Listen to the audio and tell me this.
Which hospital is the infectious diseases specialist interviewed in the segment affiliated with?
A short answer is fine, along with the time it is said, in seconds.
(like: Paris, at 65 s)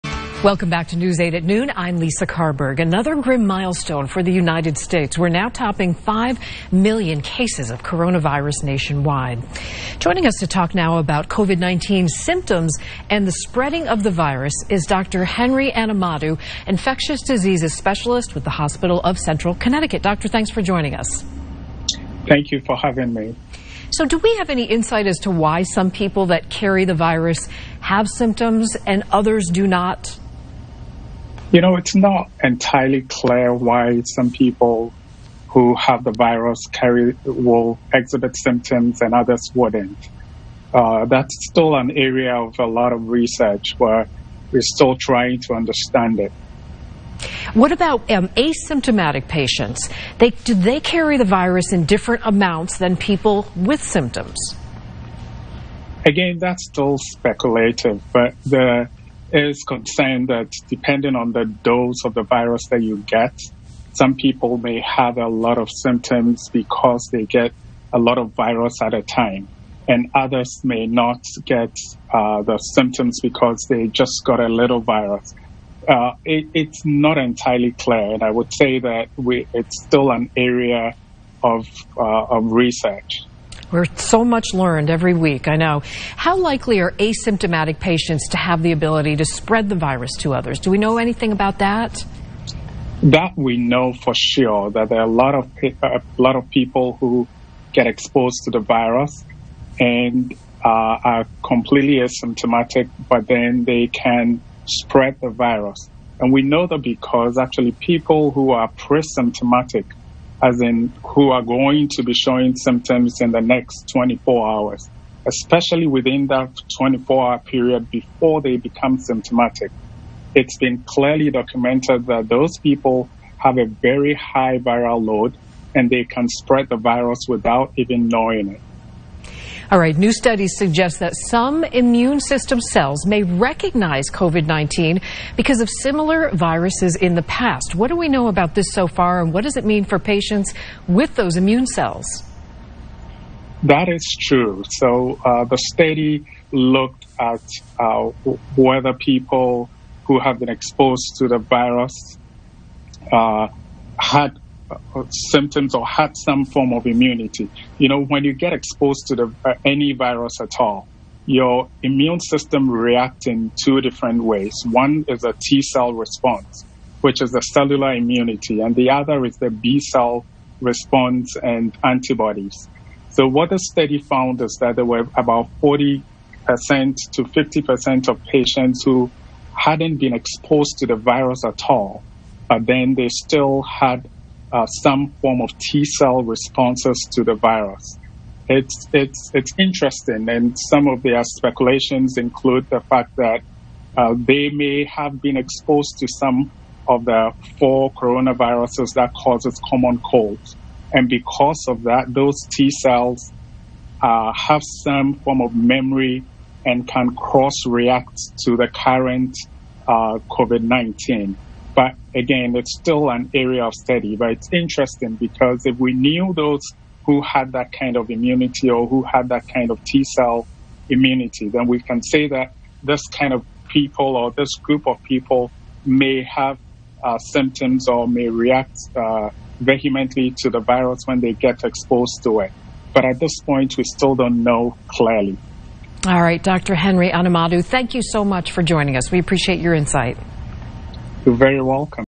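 Hospital of Central Connecticut, at 18 s.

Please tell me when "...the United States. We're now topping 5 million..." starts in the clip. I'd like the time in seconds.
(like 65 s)
4 s.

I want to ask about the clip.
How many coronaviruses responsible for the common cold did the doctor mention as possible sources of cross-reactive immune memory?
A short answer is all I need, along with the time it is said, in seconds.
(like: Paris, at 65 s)
4, at 197 s.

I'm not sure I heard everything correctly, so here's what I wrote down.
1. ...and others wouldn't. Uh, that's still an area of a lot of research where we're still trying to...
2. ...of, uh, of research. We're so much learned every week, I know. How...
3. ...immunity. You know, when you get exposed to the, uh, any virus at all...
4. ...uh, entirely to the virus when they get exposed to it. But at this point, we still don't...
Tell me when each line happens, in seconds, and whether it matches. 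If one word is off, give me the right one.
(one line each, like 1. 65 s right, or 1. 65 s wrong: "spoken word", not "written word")
1. 39 s right
2. 81 s right
3. 156 s right
4. 228 s wrong: "vehemently", not "entirely".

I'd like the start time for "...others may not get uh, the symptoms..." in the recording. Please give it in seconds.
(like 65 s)
70 s.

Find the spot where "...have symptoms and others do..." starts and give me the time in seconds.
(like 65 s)
27 s.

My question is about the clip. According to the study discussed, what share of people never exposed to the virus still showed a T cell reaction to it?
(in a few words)
40% to 50%.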